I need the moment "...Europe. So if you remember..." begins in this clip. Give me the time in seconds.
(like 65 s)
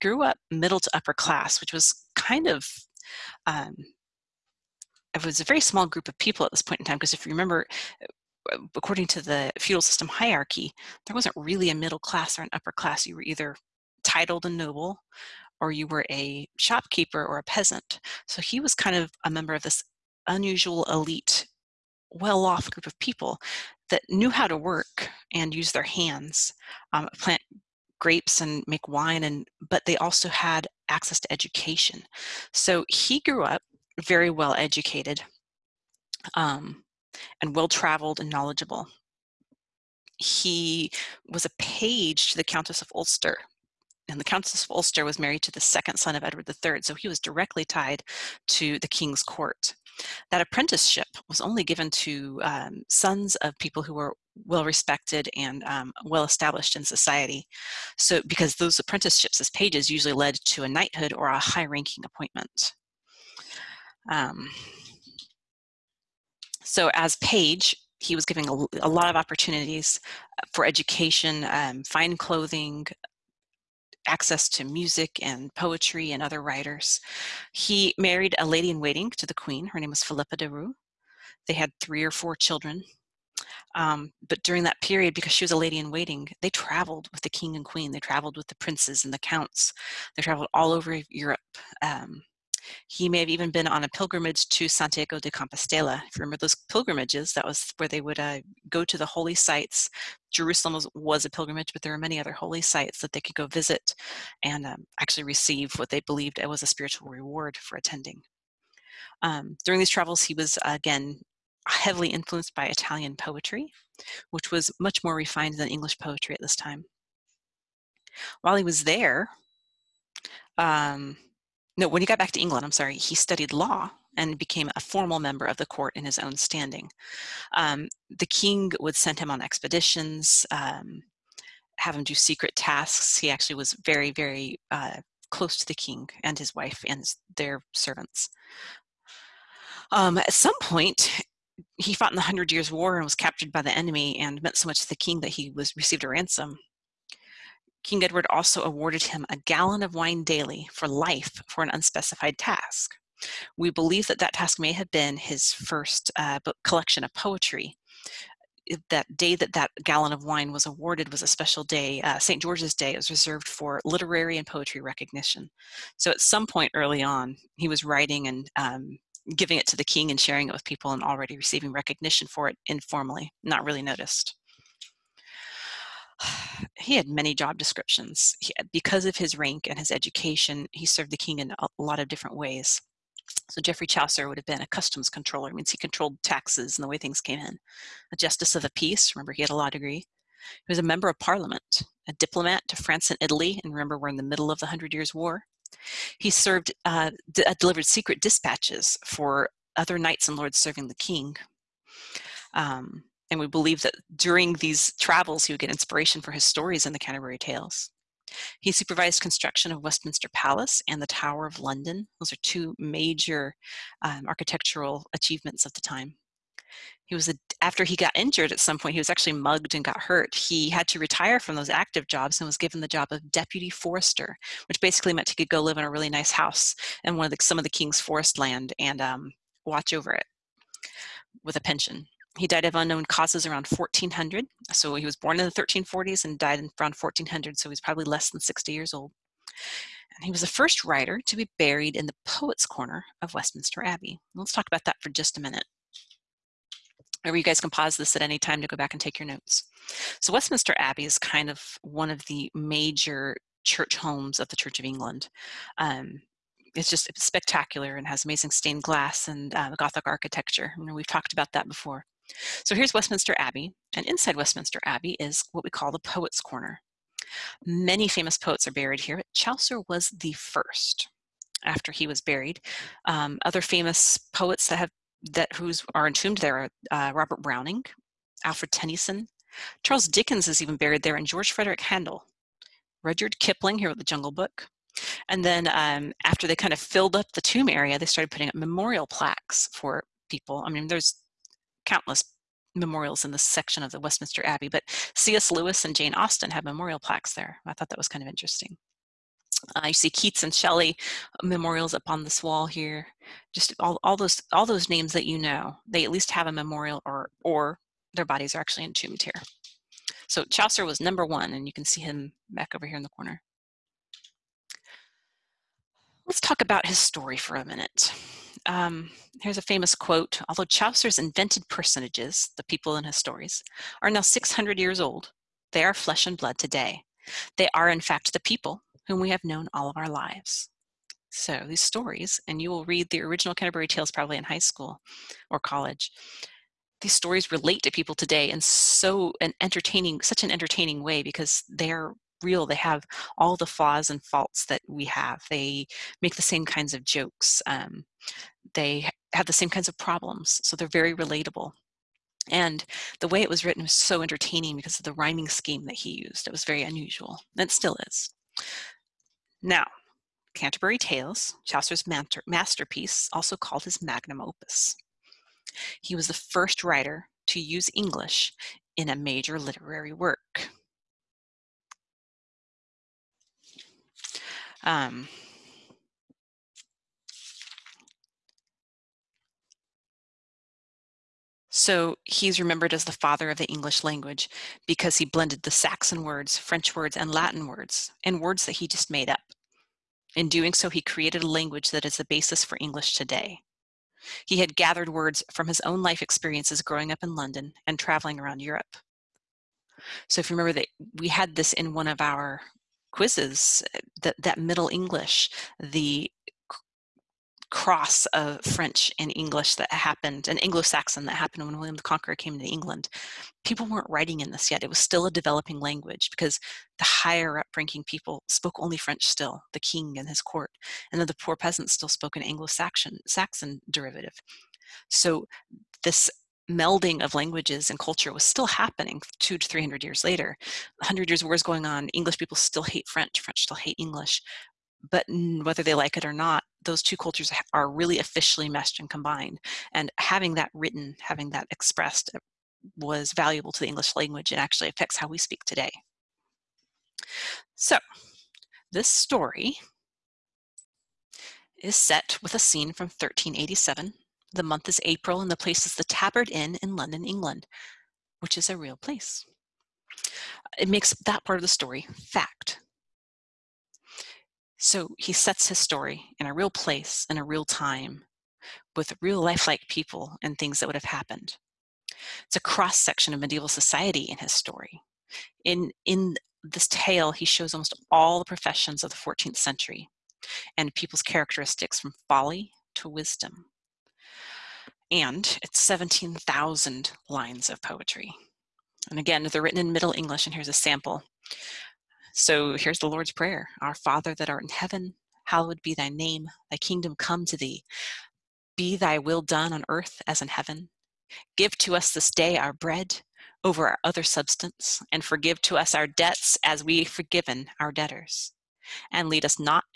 398 s.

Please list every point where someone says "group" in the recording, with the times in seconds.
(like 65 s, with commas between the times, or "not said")
5 s, 22 s.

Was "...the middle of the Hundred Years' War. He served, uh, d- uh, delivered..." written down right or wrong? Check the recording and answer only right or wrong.
right.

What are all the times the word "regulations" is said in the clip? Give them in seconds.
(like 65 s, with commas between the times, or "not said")
not said.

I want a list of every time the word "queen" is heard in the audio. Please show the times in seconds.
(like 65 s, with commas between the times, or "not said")
79 s, 87 s.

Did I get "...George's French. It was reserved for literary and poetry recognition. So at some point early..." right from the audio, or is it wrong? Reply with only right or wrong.
wrong.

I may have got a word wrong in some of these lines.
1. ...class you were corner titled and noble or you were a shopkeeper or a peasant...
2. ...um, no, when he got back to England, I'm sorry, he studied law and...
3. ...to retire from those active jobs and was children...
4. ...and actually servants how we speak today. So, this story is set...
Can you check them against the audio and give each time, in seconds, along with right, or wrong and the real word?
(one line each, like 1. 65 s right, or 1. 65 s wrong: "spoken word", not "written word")
1. 12 s wrong: "either", not "corner"
2. 120 s right
3. 220 s wrong: "given", not "children"
4. 444 s wrong: "affects", not "servants".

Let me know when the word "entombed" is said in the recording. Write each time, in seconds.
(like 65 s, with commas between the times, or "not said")
276 s, 308 s.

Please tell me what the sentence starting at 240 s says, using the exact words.
And he was the first writer to be buried in the Poets' Corner of Westminster Abbey.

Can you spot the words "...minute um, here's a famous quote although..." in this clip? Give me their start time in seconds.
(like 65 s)
317 s.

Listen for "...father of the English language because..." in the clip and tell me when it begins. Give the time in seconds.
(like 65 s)
383 s.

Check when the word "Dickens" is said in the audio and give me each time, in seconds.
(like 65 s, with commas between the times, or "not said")
280 s.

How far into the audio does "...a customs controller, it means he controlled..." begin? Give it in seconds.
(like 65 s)
184 s.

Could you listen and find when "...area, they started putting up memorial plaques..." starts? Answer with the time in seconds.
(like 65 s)
287 s.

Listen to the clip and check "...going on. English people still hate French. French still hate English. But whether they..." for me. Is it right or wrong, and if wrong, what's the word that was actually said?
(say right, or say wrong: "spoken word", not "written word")
right.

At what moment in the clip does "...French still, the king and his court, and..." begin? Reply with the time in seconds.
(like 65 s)
418 s.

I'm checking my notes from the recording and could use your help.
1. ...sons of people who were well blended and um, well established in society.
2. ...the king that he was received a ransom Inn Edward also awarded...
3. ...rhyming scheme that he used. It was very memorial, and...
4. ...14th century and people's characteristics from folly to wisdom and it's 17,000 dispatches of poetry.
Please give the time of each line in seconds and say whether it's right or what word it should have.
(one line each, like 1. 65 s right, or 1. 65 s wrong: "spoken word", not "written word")
1. 52 s wrong: "respected", not "blended"
2. 144 s wrong: "King", not "Inn"
3. 355 s wrong: "unusual", not "memorial"
4. 479 s wrong: "lines", not "dispatches".